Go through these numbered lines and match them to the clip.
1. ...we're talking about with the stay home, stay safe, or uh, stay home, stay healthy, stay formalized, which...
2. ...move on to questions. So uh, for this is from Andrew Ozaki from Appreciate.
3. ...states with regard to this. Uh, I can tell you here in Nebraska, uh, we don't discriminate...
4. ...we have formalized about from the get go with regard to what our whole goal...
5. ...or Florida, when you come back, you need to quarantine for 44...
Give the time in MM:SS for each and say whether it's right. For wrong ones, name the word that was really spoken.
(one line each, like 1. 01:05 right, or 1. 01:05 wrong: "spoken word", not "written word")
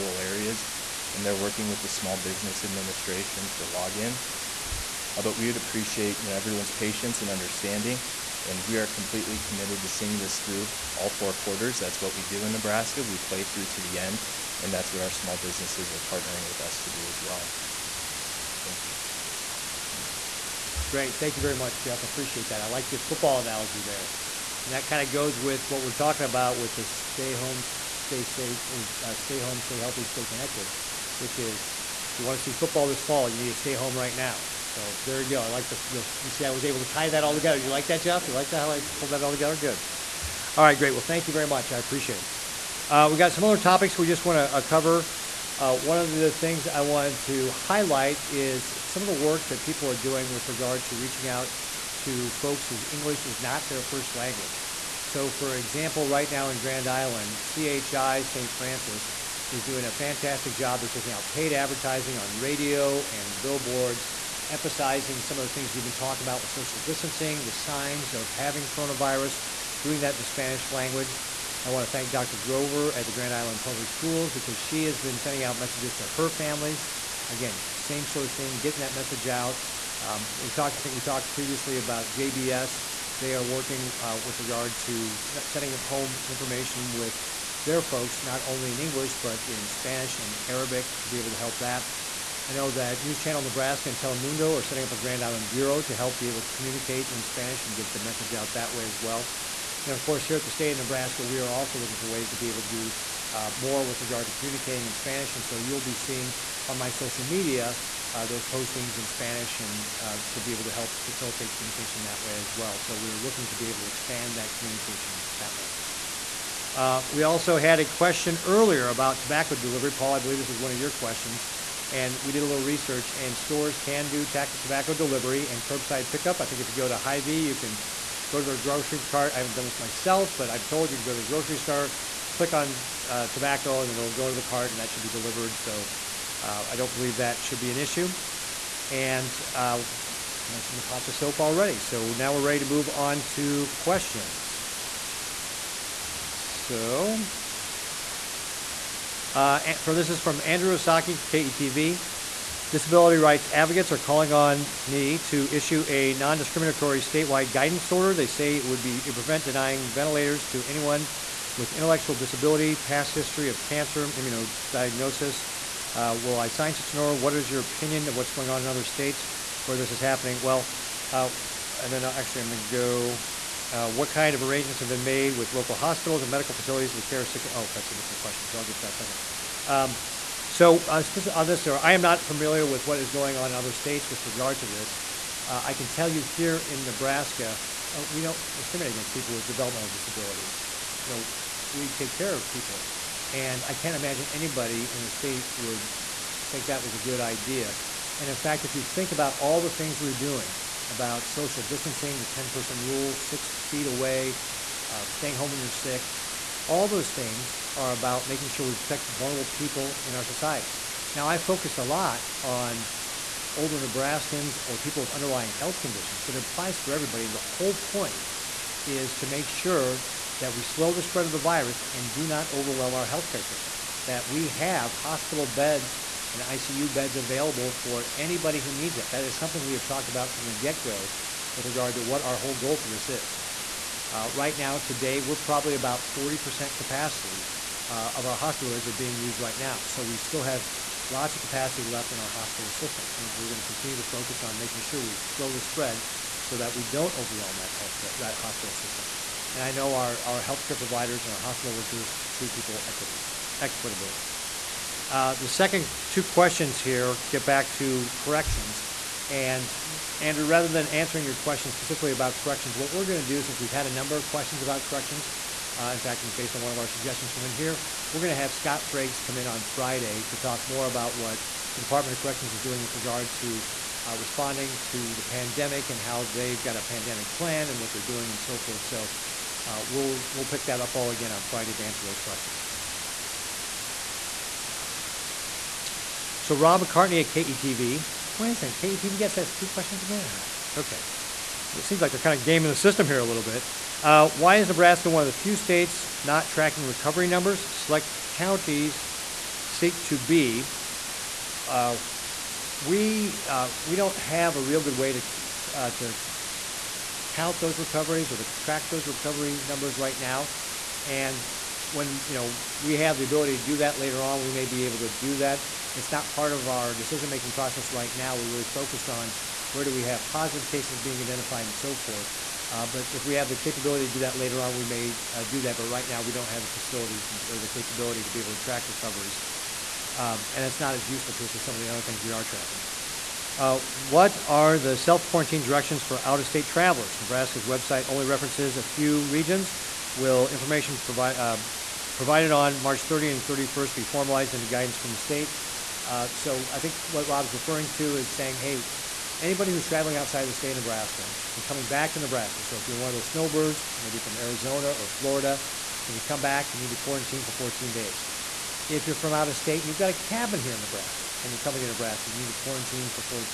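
1. 00:25 wrong: "connected", not "formalized"
2. 02:22 wrong: "KETV", not "Appreciate"
3. 03:03 right
4. 03:49 wrong: "talked", not "formalized"
5. 05:54 wrong: "14", not "44".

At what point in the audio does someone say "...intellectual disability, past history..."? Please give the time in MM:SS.
02:41.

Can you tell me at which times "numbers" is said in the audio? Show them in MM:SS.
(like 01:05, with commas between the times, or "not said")
04:23, 04:57, 05:09.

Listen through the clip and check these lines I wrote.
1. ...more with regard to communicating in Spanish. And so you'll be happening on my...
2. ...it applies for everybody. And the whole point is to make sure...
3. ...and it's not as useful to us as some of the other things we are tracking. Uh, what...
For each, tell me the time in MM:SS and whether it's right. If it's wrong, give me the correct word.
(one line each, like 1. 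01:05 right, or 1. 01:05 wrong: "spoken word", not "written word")
1. 01:43 wrong: "seeing", not "happening"
2. 03:36 right
3. 05:30 right.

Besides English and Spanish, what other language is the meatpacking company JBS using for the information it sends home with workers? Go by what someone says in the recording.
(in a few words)
Arabic.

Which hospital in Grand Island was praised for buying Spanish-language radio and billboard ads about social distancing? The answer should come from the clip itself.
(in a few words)
CHI St. Francis.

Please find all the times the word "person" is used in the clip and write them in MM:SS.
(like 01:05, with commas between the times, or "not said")
03:22.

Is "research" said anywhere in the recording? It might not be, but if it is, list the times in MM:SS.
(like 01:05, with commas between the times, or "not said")
02:02.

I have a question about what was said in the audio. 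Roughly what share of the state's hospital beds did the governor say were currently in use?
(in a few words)
40%.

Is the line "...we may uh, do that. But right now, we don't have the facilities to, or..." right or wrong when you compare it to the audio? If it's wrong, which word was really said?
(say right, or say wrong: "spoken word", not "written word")
right.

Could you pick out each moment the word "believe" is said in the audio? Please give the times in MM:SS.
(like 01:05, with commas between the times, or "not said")
02:00, 02:16.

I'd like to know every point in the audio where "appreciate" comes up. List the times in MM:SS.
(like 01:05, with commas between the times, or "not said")
00:05, 00:22, 00:41.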